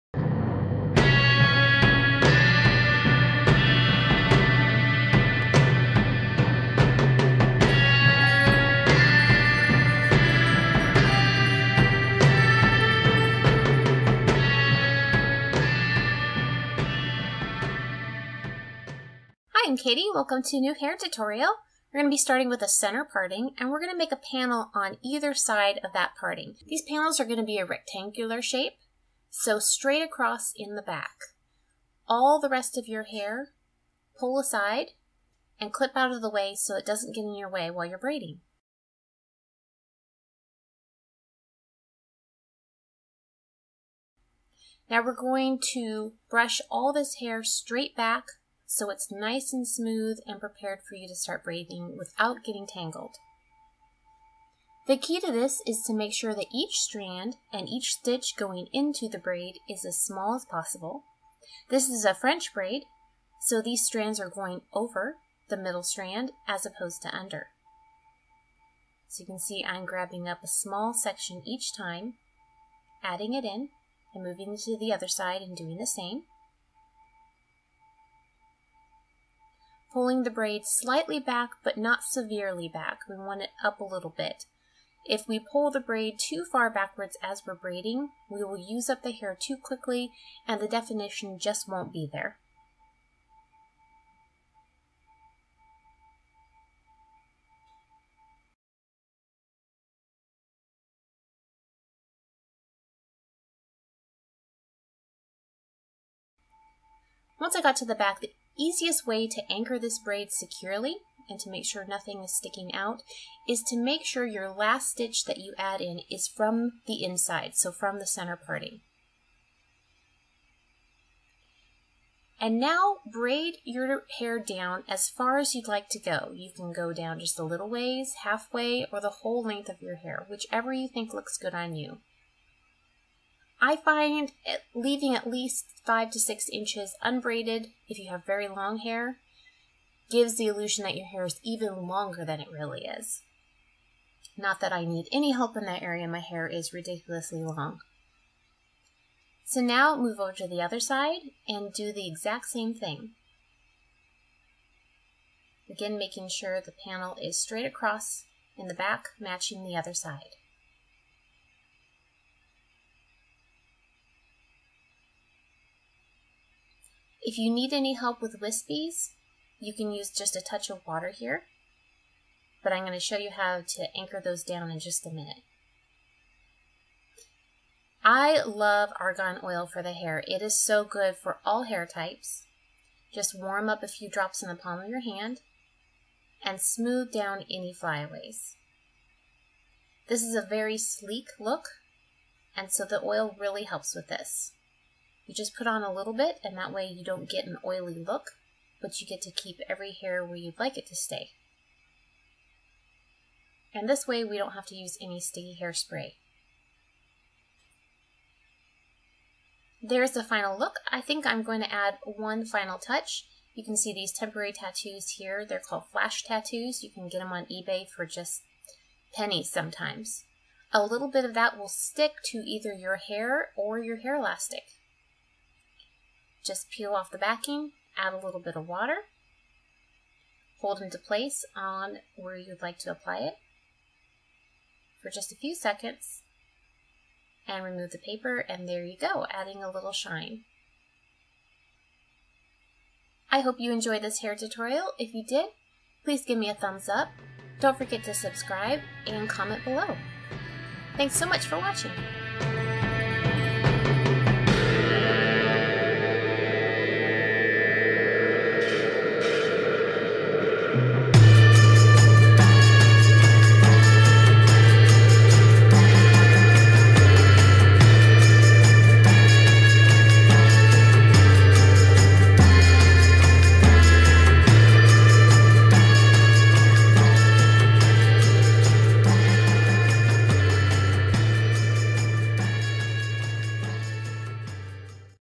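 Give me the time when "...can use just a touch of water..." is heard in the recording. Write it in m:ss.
2:49.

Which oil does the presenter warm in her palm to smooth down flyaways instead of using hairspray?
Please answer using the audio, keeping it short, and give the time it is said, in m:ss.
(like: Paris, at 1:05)
Argan oil, at 2:58.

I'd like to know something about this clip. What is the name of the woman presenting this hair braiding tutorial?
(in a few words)
Katie.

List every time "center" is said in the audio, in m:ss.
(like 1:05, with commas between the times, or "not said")
0:22, 1:58.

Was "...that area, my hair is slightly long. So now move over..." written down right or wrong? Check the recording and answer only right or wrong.
wrong.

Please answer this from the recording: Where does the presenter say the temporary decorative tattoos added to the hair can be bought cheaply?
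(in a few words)
eBay.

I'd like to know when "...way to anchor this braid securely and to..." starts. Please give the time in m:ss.
1:49.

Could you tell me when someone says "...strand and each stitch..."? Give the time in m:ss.
0:56.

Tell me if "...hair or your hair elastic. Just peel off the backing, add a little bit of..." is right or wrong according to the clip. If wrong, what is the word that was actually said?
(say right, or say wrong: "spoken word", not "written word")
right.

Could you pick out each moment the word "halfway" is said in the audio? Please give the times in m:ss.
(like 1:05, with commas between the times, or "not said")
2:08.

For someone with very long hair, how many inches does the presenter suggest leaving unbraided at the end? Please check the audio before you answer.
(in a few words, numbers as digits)
5 to 6 inches.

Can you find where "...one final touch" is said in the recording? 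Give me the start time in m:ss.
3:32.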